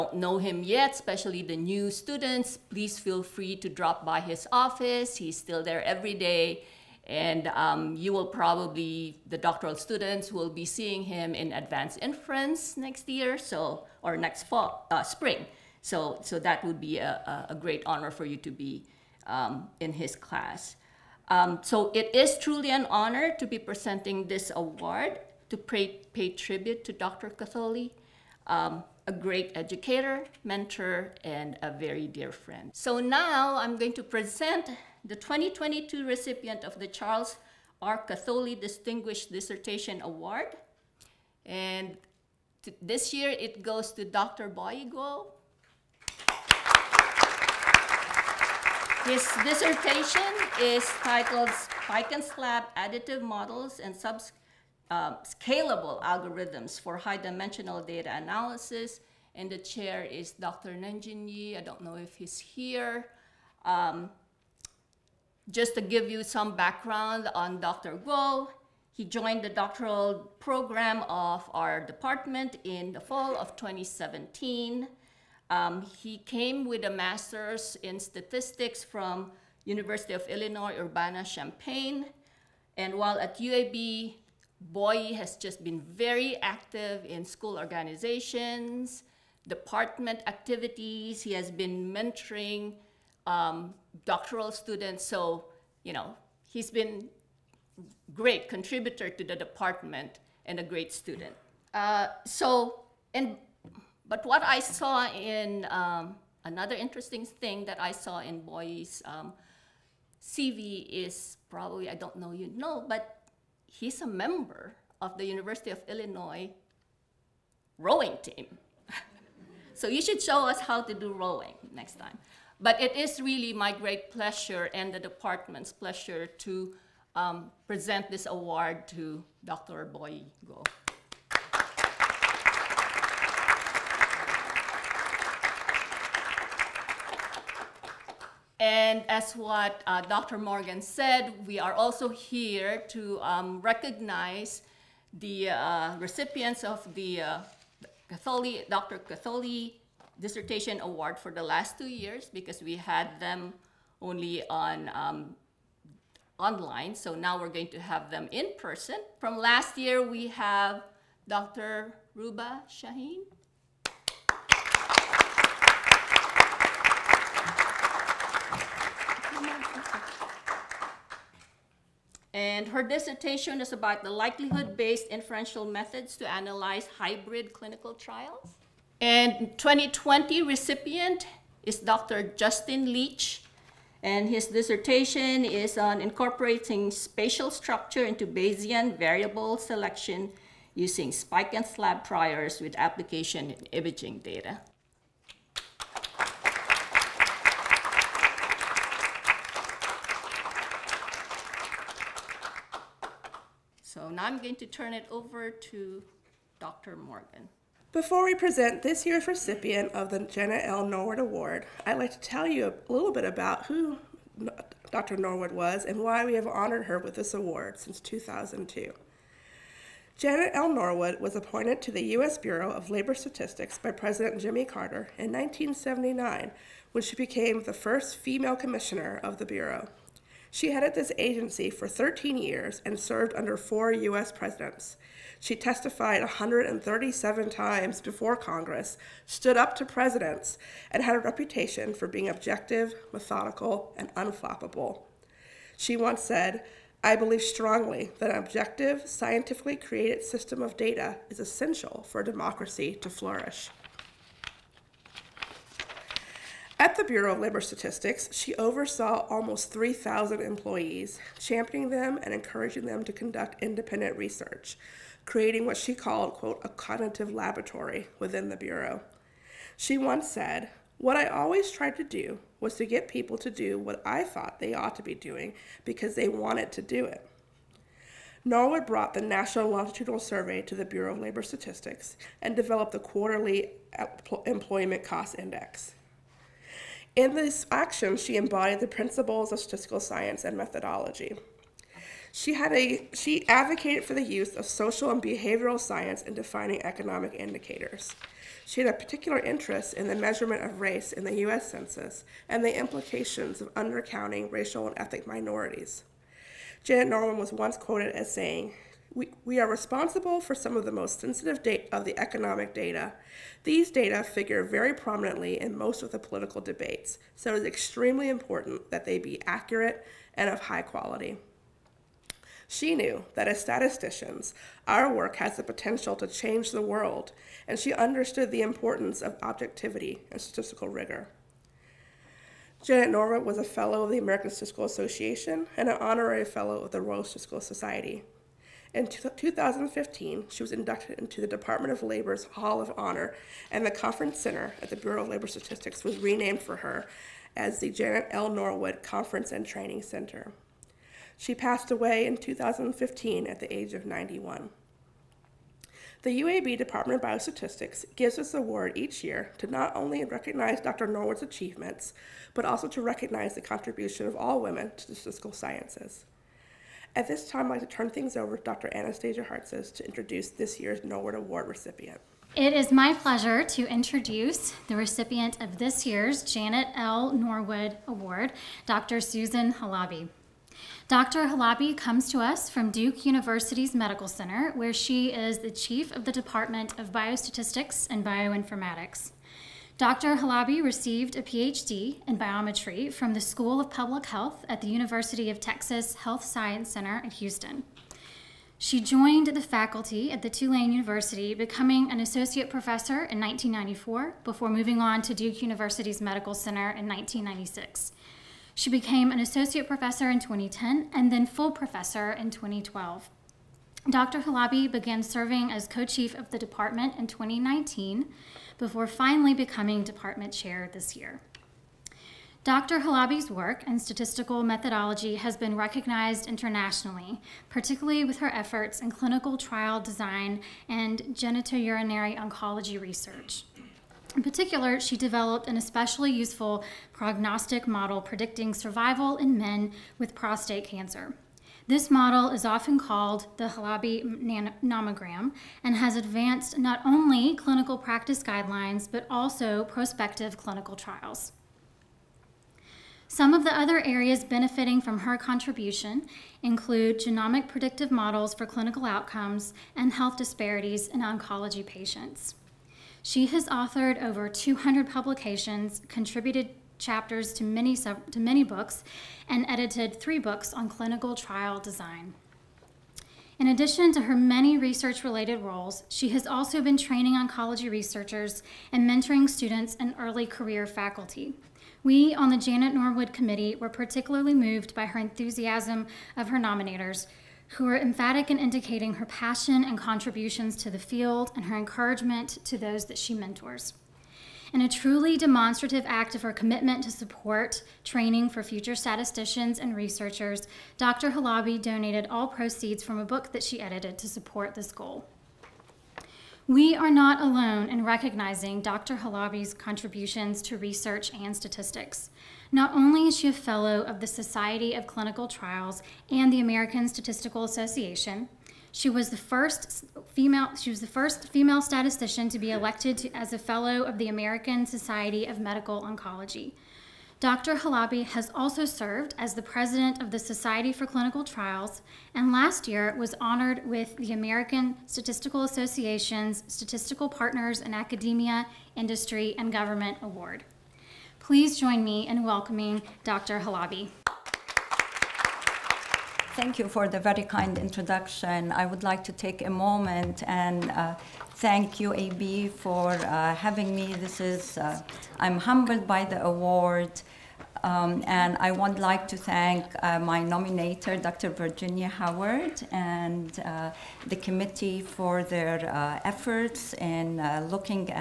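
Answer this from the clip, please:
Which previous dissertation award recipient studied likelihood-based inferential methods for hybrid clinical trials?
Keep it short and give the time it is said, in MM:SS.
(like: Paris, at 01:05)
Ruba Shaheen, at 02:42.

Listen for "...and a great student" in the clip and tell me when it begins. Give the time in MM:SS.
01:40.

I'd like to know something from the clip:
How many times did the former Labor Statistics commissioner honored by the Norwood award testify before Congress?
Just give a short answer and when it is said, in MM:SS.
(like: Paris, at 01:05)
137, at 03:56.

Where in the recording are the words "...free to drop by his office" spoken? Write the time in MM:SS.
00:03.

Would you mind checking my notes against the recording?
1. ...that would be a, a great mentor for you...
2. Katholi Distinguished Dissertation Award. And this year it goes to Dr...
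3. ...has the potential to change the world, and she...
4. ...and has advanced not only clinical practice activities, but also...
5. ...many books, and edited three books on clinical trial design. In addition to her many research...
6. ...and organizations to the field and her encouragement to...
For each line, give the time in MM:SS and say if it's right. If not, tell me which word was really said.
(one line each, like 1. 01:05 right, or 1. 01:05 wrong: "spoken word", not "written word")
1. 00:16 wrong: "honor", not "mentor"
2. 00:38 right
3. 05:25 right
4. 07:25 wrong: "guidelines", not "activities"
5. 07:48 right
6. 08:09 wrong: "contributions", not "organizations".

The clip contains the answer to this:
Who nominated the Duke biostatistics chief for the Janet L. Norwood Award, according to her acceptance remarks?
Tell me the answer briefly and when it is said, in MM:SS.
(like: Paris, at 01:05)
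Virginia Howard, at 09:21.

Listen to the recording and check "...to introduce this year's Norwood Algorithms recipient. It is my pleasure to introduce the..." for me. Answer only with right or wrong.
wrong.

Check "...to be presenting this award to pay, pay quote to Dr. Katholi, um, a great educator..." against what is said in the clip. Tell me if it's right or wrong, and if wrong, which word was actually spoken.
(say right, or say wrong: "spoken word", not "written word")
wrong: "tribute", not "quote".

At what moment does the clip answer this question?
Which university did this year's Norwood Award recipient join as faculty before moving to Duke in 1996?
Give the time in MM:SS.
06:40.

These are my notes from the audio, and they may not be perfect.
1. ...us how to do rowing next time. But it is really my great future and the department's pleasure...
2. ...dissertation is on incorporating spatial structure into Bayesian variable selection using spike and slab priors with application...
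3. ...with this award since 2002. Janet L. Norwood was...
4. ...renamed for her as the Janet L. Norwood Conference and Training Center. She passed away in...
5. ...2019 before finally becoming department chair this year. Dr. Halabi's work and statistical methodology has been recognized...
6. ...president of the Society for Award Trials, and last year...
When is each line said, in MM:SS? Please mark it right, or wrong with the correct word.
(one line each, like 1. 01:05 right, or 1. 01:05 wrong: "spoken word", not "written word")
1. 02:00 wrong: "pleasure", not "future"
2. 03:04 right
3. 03:36 right
4. 05:46 right
5. 06:57 right
6. 08:49 wrong: "Clinical", not "Award".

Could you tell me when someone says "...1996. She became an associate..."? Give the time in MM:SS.
06:47.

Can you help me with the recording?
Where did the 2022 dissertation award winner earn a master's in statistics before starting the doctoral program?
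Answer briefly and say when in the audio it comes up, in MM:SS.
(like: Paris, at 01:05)
University of Illinois Urbana-Champaign, at 01:19.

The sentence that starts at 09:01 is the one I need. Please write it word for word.
Please join me in welcoming Dr.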